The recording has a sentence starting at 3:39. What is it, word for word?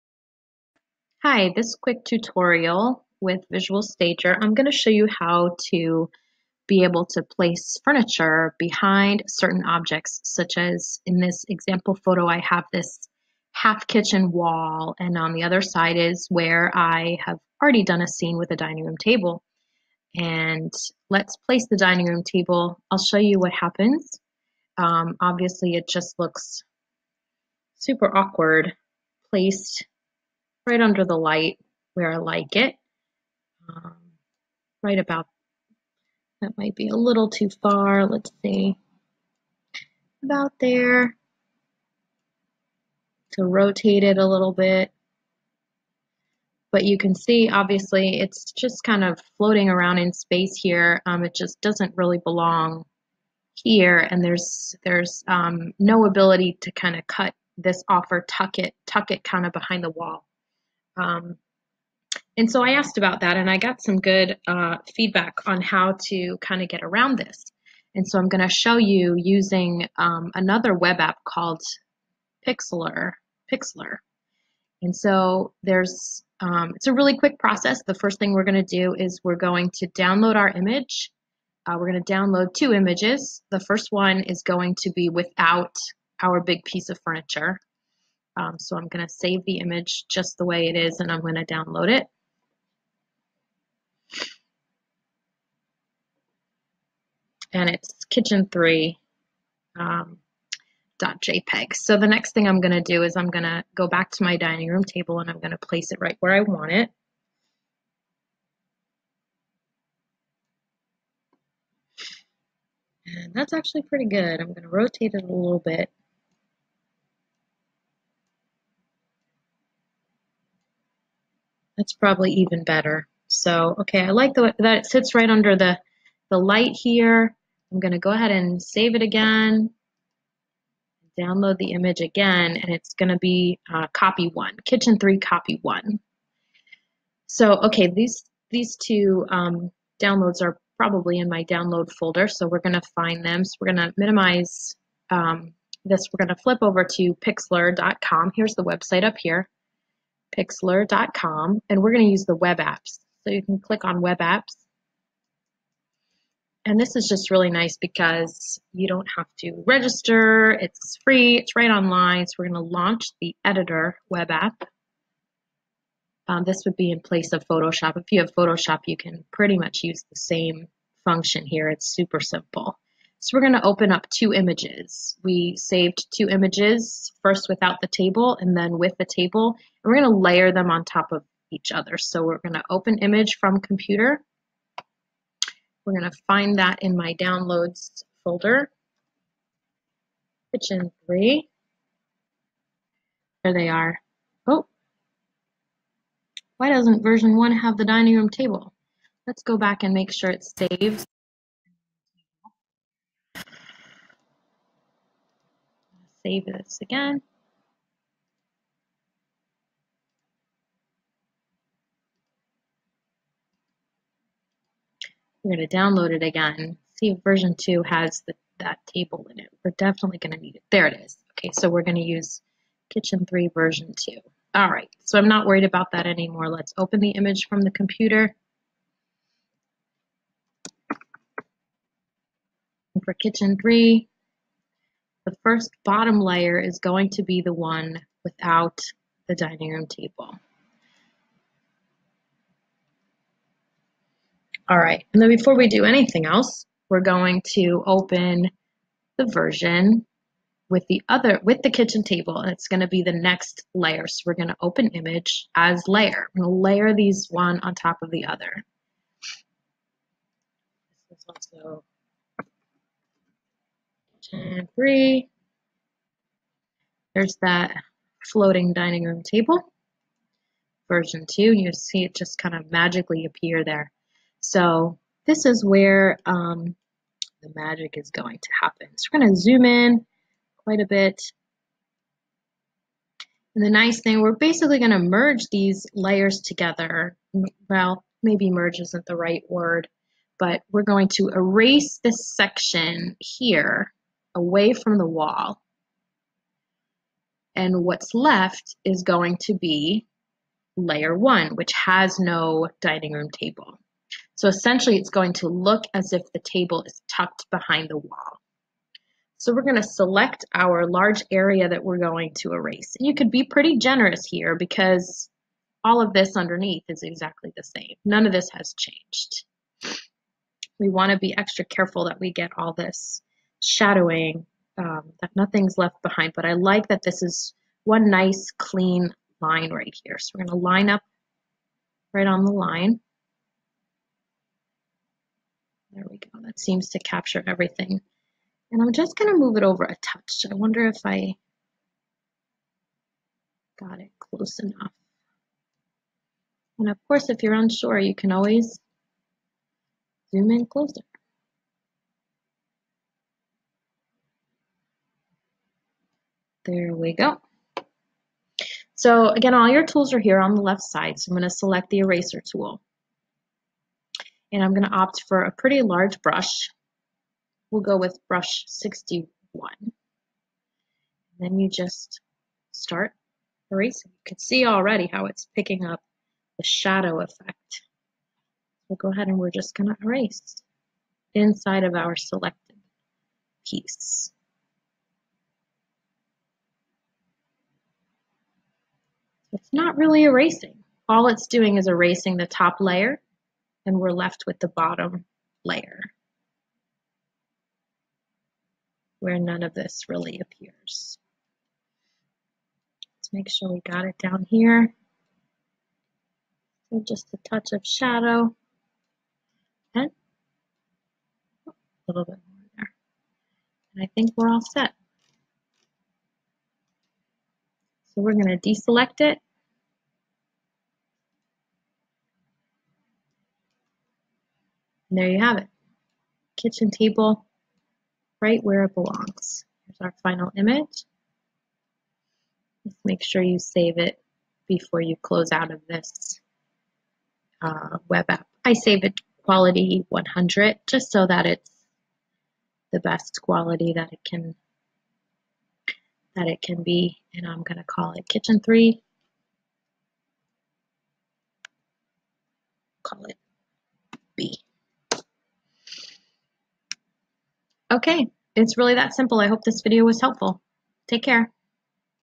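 We're definitely going to need it.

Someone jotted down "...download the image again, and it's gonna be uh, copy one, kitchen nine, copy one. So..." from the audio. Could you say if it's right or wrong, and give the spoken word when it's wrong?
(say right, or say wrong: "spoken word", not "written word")
wrong: "three", not "nine".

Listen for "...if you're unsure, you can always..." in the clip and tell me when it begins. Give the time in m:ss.
5:47.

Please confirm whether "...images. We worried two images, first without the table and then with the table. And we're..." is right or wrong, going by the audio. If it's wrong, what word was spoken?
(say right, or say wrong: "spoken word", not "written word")
wrong: "saved", not "worried".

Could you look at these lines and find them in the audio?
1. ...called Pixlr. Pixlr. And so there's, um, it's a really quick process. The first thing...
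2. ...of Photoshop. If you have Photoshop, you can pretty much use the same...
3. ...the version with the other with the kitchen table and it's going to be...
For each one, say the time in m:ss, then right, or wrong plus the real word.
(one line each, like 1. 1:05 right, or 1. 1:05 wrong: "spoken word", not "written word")
1. 1:11 right
2. 2:47 right
3. 4:09 right.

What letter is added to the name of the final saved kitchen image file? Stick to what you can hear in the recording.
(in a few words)
B.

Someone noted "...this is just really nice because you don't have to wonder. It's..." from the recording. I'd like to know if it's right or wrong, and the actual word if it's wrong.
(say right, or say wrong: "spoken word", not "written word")
wrong: "register", not "wonder".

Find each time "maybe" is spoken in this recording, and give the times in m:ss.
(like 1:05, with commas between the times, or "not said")
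4:48.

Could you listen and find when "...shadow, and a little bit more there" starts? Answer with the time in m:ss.
6:47.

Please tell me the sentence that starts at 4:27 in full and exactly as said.
There's that floating dining room table.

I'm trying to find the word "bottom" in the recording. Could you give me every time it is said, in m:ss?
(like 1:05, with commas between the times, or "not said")
3:55, 6:34.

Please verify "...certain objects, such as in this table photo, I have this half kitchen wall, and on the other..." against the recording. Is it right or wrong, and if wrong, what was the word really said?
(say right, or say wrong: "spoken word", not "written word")
wrong: "example", not "table".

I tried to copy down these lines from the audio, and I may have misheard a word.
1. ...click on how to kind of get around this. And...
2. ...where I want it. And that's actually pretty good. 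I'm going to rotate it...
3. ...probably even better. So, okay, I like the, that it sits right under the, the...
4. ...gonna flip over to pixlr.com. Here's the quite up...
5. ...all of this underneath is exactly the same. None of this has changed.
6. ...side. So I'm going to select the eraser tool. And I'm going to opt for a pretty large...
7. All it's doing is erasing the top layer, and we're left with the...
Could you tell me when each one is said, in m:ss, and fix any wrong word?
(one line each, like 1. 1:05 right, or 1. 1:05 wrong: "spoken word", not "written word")
1. 1:04 wrong: "feedback", not "click"
2. 1:46 right
3. 2:01 right
4. 2:26 wrong: "website", not "quite"
5. 5:15 right
6. 6:00 right
7. 6:31 right.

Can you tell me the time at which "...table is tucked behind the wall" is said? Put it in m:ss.
5:06.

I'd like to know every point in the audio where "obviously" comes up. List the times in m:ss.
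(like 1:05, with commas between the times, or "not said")
0:25, 0:47.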